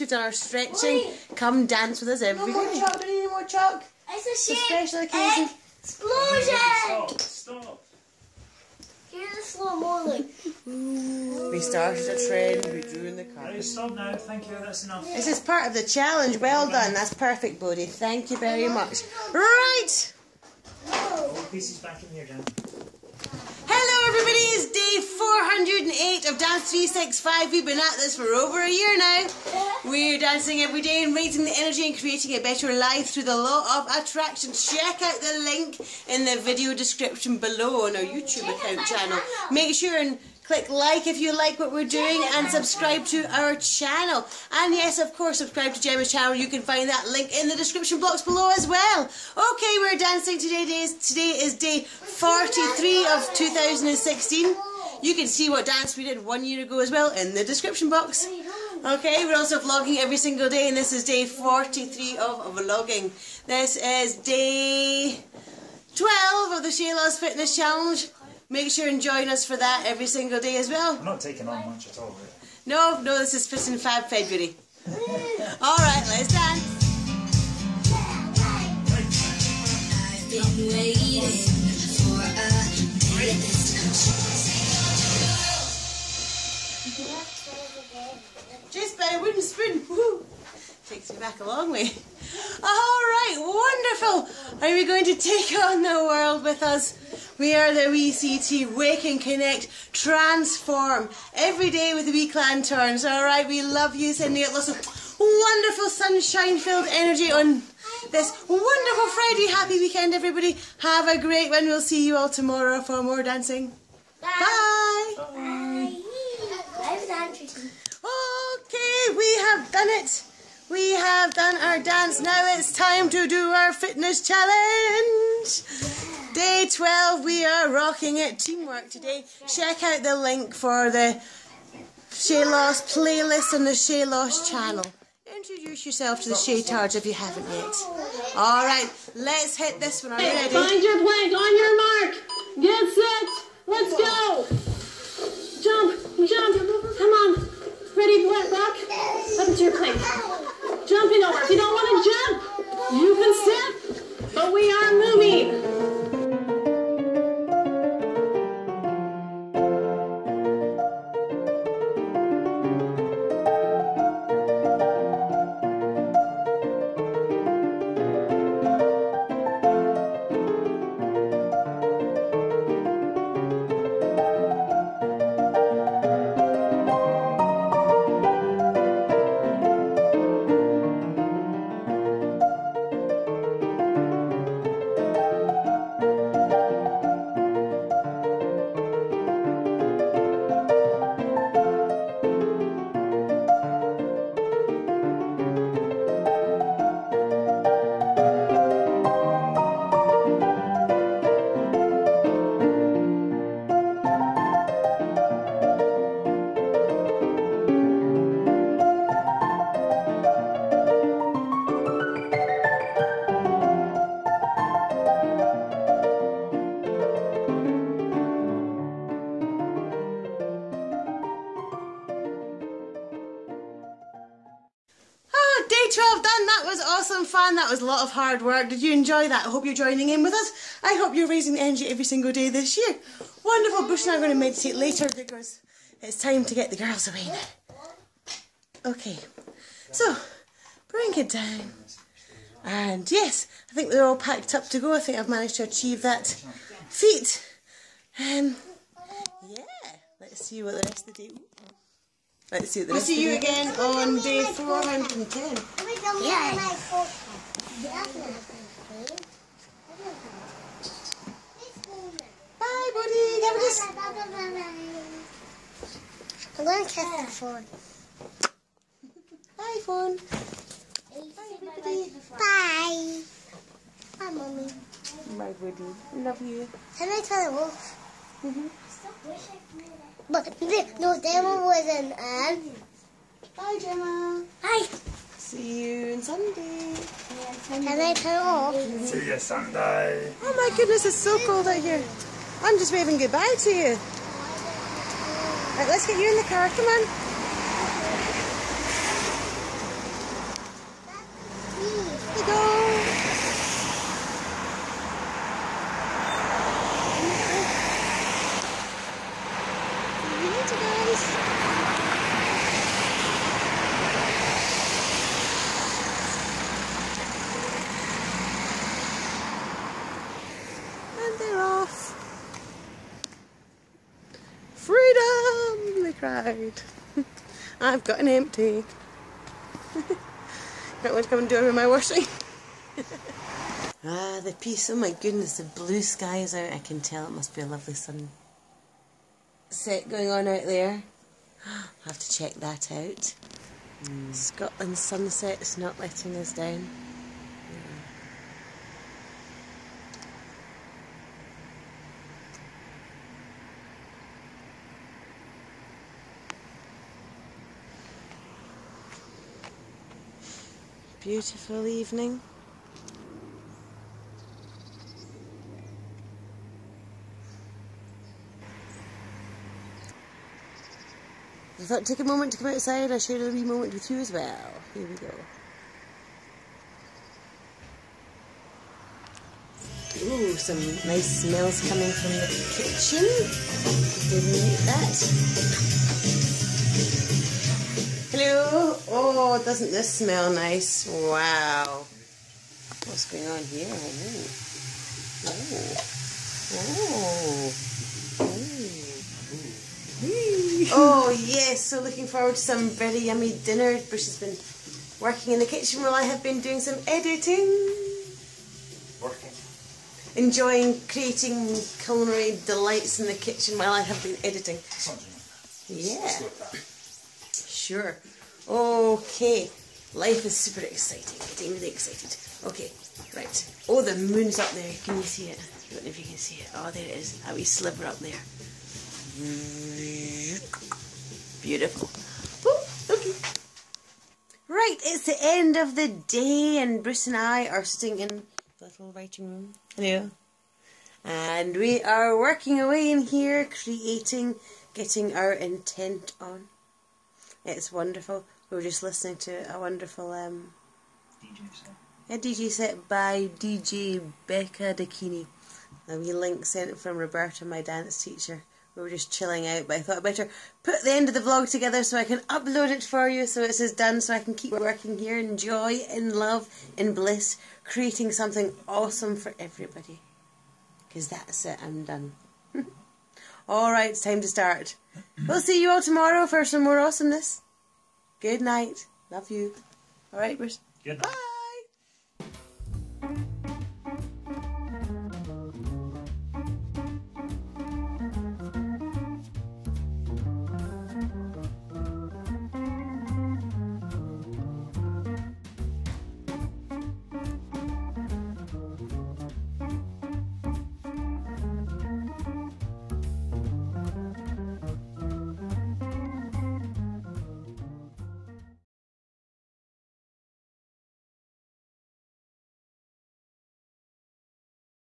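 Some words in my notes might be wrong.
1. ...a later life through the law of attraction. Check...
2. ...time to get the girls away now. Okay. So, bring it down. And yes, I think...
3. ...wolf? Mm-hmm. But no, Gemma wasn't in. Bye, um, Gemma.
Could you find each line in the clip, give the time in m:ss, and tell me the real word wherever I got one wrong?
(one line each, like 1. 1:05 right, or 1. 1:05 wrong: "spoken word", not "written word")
1. 0:32 wrong: "better", not "later"
2. 3:56 right
3. 4:37 right.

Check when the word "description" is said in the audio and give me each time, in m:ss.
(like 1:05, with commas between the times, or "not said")
0:36, 0:47, 0:57.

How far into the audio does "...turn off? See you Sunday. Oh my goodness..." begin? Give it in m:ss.
4:48.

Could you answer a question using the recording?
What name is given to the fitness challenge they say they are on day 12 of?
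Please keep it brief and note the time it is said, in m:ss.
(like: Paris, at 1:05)
ShayLoss Fitness Challenge, at 1:06.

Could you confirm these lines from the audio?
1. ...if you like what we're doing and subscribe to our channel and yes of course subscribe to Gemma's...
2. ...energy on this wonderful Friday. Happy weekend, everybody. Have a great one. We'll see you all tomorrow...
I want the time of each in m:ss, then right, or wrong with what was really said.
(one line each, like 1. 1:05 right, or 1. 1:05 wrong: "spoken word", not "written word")
1. 0:41 right
2. 1:46 right.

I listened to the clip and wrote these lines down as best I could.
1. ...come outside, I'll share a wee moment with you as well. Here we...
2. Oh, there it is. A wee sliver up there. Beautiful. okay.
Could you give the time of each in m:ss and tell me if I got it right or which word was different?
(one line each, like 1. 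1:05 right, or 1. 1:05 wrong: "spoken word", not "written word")
1. 6:12 right
2. 7:06 right.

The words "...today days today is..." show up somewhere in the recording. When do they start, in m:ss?
0:50.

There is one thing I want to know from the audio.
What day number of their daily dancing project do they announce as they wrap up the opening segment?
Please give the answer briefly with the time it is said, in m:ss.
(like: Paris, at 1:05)
408, at 0:24.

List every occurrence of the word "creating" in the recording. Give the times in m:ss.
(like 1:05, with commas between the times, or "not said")
0:31, 6:51, 7:23, 7:47.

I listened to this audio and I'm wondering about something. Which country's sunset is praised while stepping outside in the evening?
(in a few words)
Scotland.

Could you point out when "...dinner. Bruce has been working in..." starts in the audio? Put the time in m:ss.
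6:43.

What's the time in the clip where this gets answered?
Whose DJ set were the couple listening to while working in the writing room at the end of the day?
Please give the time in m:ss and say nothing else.
7:33.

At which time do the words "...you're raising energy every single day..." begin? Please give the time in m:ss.
3:51.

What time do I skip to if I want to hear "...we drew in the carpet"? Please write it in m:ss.
0:12.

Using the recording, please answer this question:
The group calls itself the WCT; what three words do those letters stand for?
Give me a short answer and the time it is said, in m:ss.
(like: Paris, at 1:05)
Wake and Connect Transform, at 1:38.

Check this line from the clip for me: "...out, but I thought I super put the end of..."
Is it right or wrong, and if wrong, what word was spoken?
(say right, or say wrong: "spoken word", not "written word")
wrong: "better", not "super".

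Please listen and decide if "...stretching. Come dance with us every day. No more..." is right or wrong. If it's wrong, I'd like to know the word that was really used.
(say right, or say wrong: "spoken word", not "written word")
right.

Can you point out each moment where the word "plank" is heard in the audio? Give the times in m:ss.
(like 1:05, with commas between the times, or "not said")
2:21.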